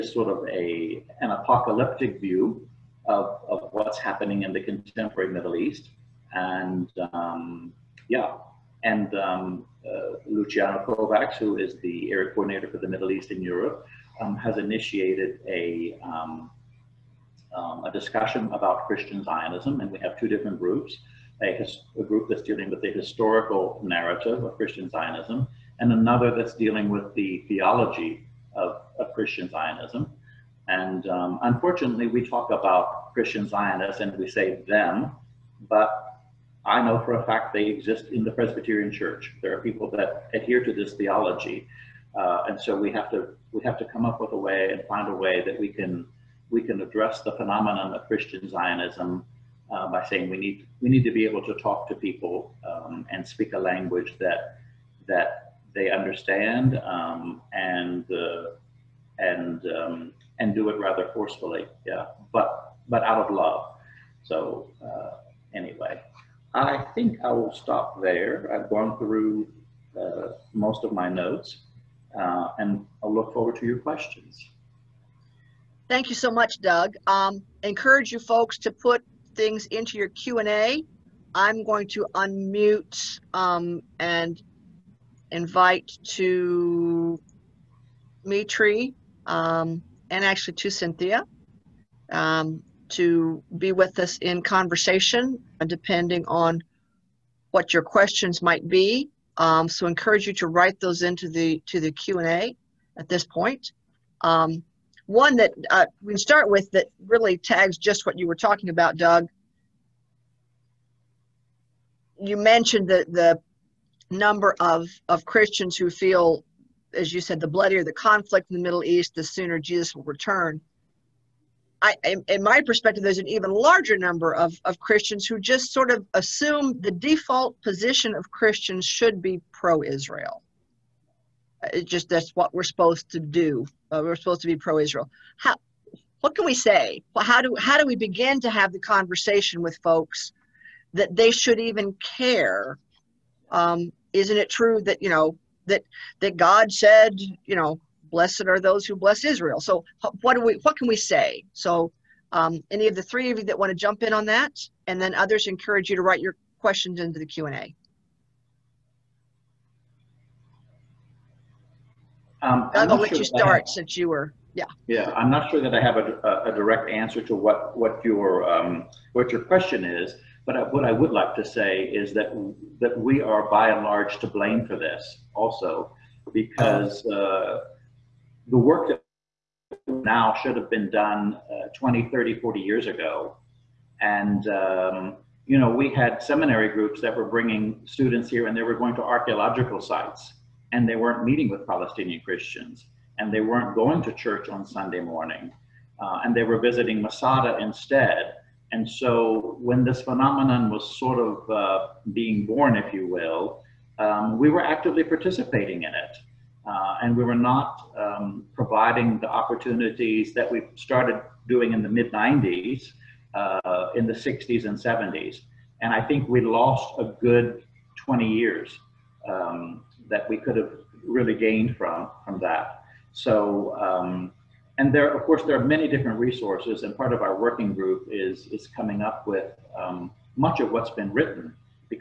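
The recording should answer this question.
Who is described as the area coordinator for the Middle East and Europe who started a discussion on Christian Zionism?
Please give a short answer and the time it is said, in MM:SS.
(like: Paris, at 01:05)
Luciano Kovacs, at 00:10.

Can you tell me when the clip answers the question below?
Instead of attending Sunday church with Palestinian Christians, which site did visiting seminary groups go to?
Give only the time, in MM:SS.
03:17.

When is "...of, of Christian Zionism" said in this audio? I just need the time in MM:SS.
00:28.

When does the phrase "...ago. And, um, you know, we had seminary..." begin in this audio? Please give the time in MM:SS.
03:02.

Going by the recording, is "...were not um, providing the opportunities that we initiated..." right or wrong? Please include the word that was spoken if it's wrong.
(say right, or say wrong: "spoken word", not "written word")
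wrong: "started", not "initiated".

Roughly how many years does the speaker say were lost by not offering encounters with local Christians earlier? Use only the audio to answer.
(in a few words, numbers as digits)
20.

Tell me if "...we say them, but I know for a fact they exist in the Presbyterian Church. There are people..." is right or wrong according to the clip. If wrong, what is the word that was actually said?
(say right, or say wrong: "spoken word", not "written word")
right.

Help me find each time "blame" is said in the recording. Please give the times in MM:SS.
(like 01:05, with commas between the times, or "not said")
02:54.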